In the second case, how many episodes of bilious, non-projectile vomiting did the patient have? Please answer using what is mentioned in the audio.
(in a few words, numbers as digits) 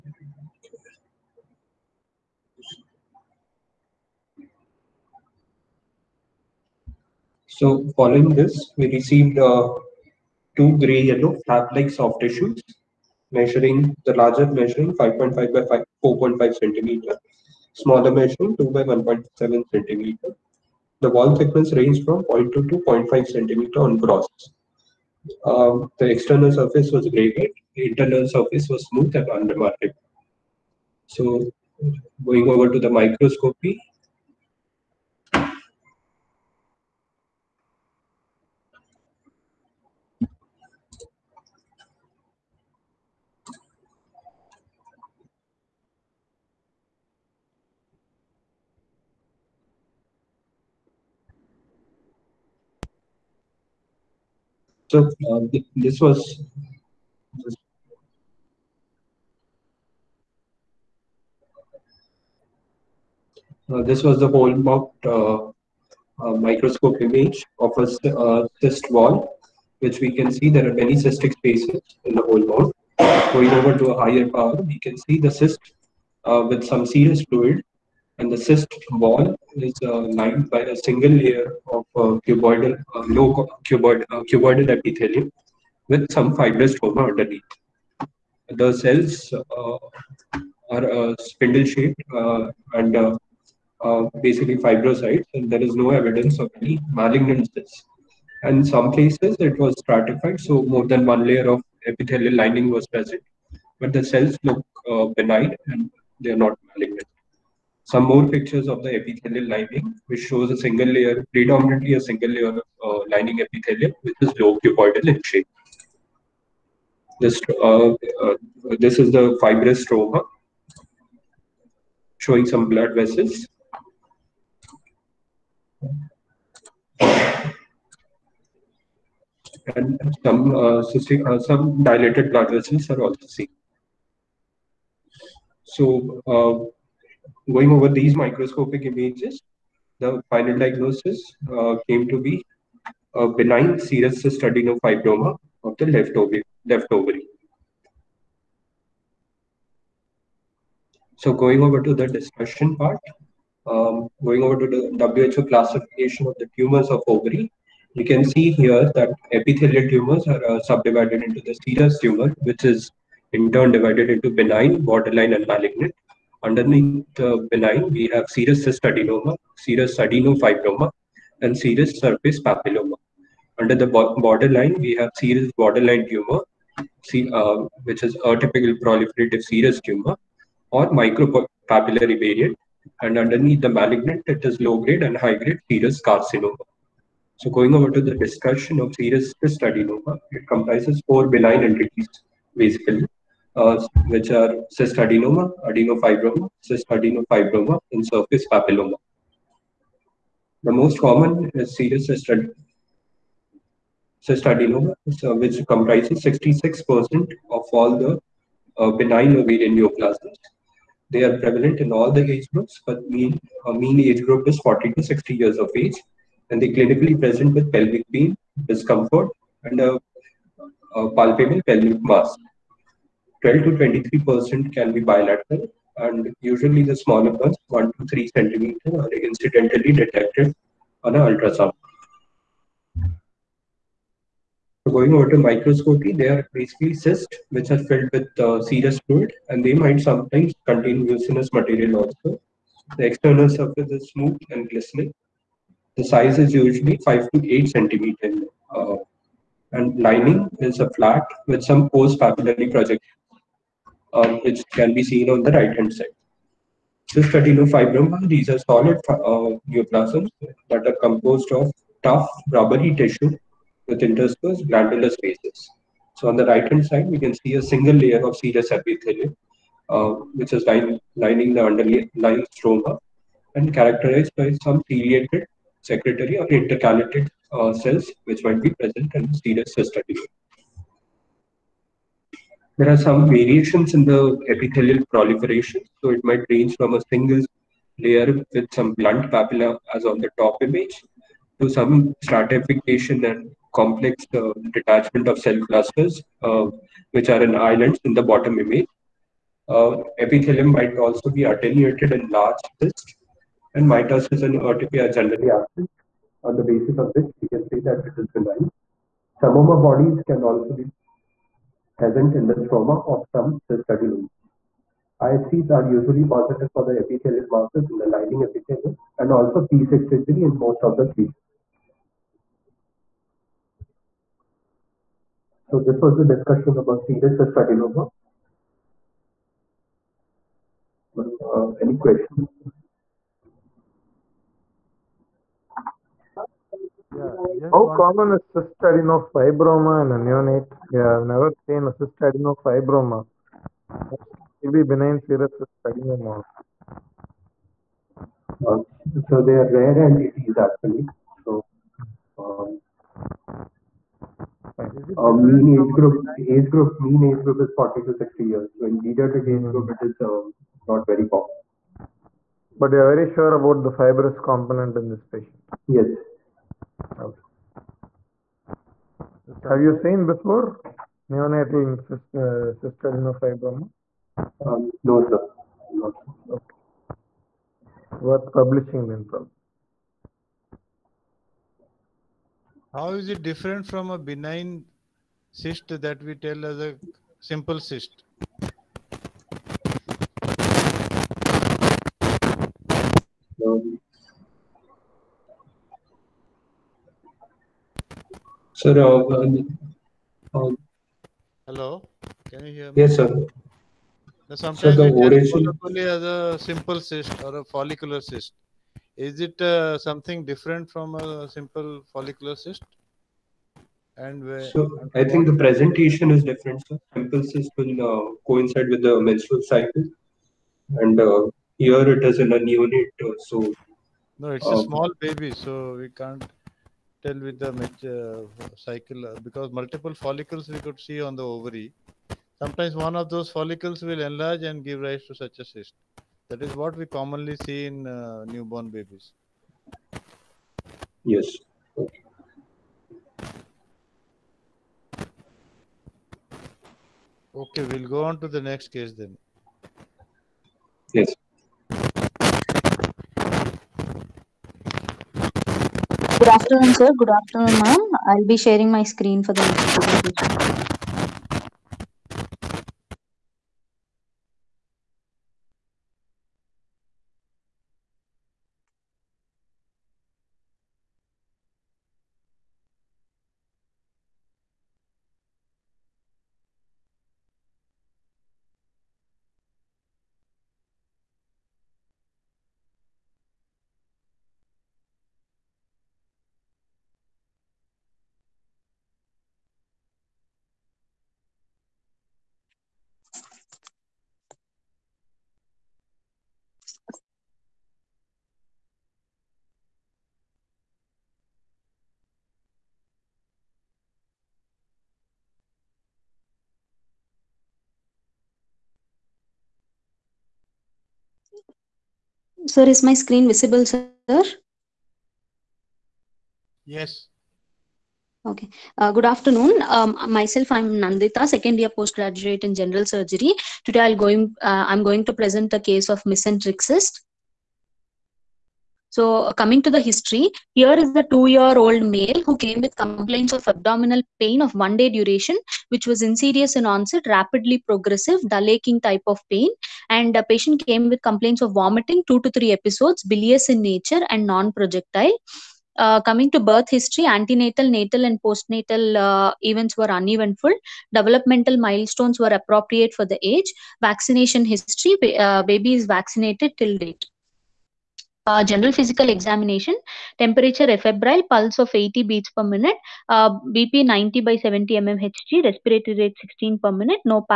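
2 to 3.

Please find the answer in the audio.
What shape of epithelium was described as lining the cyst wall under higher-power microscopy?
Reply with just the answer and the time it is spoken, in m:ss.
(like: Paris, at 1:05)
Low cuboidal, at 1:54.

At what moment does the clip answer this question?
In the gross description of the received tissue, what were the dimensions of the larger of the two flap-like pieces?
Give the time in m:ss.
0:14.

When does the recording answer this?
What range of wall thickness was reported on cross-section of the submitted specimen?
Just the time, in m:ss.
0:22.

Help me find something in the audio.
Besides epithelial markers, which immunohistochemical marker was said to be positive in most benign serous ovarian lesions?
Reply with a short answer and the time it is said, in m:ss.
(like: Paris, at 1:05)
P63, at 5:19.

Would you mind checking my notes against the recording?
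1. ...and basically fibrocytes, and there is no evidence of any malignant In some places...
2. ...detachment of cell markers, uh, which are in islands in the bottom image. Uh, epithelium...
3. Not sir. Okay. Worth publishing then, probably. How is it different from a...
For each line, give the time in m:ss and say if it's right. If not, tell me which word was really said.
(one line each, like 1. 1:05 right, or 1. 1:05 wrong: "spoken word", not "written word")
1. 1:32 right
2. 4:54 wrong: "clusters", not "markers"
3. 6:15 right.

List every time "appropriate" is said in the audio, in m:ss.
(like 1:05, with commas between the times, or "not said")
9:12.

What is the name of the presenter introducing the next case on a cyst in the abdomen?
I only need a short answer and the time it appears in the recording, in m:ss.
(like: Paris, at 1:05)
Nandita, at 8:41.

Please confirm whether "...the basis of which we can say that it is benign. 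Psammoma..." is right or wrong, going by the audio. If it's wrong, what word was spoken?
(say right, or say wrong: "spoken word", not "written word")
right.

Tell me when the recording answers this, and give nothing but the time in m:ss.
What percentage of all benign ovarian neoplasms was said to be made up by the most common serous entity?
3:26.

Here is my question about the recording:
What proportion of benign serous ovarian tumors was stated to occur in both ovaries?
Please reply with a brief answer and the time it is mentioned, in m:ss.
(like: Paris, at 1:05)
12 to 23 percent, at 3:43.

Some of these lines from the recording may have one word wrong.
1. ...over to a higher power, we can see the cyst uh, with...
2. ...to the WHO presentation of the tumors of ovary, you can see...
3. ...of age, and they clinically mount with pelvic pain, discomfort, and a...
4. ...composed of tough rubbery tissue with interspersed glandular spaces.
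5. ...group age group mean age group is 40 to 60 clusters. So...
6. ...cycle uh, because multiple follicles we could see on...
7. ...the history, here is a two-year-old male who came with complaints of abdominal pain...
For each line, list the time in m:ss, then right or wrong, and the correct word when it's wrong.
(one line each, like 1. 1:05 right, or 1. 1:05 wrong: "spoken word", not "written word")
1. 1:13 right
2. 2:34 wrong: "classification", not "presentation"
3. 3:35 wrong: "present", not "mount"
4. 4:21 right
5. 5:55 wrong: "years", not "clusters"
6. 7:08 right
7. 8:49 right.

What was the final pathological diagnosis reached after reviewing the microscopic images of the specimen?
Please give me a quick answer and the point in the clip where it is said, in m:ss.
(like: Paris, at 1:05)
Benign serous cystadenofibroma, at 2:23.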